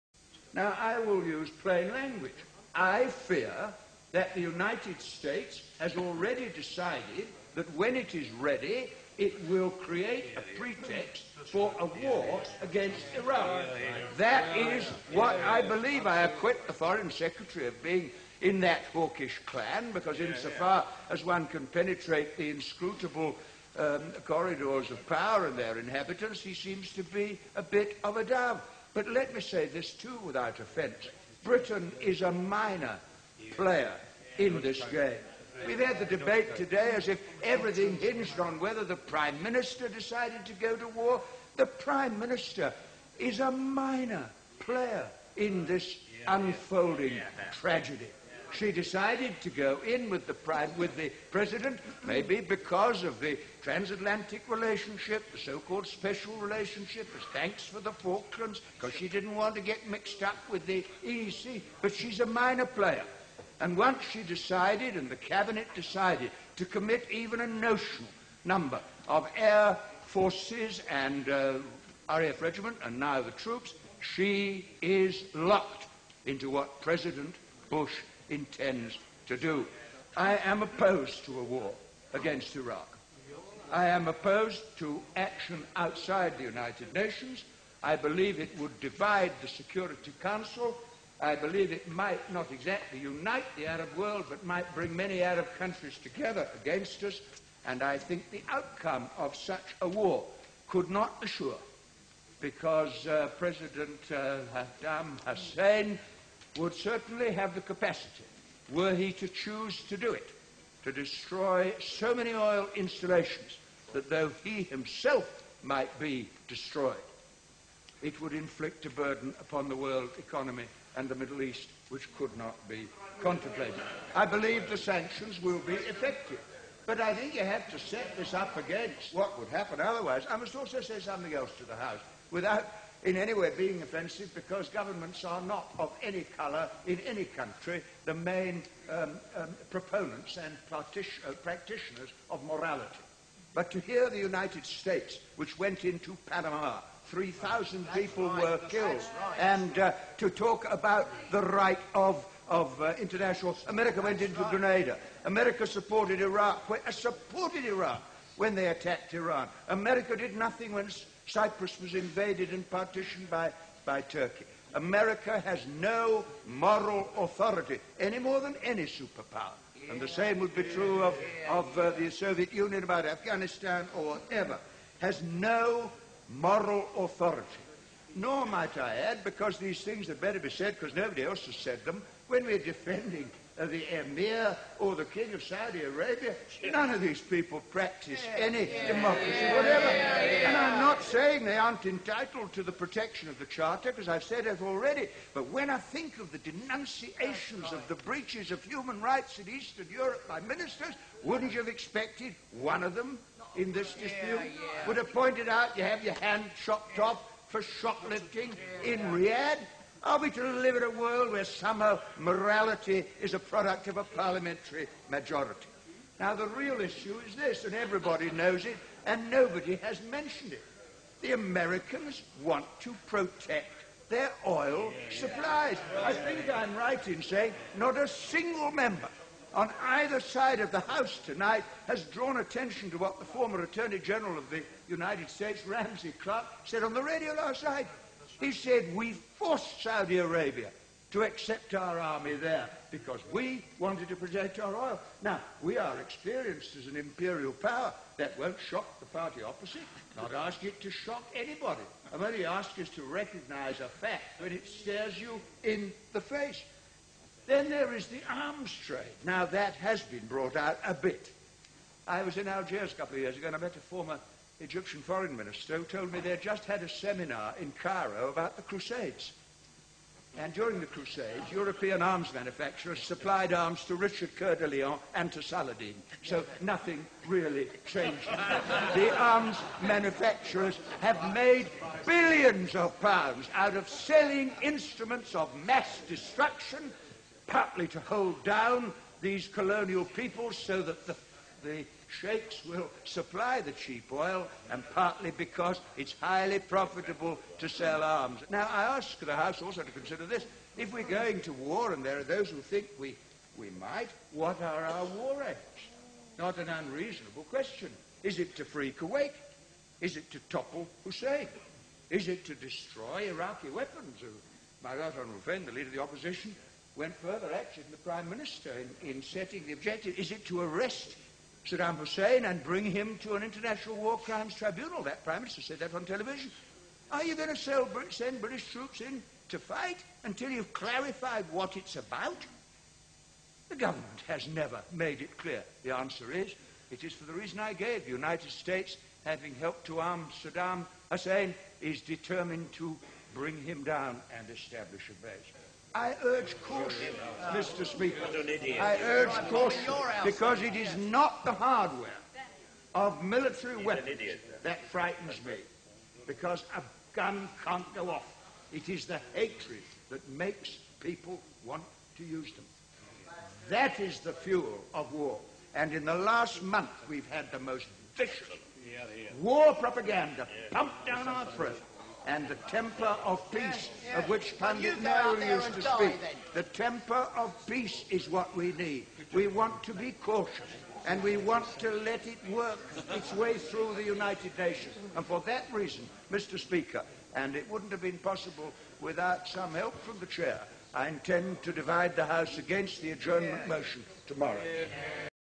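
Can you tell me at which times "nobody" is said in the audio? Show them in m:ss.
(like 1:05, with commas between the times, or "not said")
3:00, 3:39.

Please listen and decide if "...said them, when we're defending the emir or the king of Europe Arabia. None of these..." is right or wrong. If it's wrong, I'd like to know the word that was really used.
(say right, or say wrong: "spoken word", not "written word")
wrong: "Saudi", not "Europe".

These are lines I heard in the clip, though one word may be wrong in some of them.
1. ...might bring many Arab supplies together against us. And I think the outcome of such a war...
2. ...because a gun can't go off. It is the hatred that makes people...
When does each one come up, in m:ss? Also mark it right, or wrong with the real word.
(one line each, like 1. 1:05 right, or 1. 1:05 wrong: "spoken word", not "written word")
1. 1:34 wrong: "countries", not "supplies"
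2. 5:56 right.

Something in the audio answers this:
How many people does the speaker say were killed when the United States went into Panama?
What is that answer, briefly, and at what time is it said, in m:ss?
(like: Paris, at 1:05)
3,000, at 2:27.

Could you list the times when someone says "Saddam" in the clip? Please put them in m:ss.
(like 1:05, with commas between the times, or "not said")
1:44, 5:21, 5:40.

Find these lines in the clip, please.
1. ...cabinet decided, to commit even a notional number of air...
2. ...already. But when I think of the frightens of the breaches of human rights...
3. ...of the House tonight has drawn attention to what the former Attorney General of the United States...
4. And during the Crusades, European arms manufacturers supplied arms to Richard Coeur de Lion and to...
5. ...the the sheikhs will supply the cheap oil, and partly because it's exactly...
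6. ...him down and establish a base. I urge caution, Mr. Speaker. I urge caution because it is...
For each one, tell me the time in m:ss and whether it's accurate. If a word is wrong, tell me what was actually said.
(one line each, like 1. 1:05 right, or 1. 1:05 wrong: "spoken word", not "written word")
1. 1:05 right
2. 3:14 wrong: "denunciations", not "frightens"
3. 3:50 right
4. 4:30 right
5. 4:51 wrong: "highly", not "exactly"
6. 5:43 right.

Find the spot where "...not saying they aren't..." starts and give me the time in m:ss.
3:10.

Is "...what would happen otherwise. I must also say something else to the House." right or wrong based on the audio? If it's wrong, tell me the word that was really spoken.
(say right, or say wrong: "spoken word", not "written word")
right.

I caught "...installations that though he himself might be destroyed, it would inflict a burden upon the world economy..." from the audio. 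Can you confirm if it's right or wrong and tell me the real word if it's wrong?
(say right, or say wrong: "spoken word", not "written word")
right.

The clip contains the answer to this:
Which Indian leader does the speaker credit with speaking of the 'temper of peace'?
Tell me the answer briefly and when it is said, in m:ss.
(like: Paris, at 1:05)
Pandit Nehru, at 6:14.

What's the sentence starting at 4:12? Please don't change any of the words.
I'm only asking us to recognize a fact when it stares you in the face.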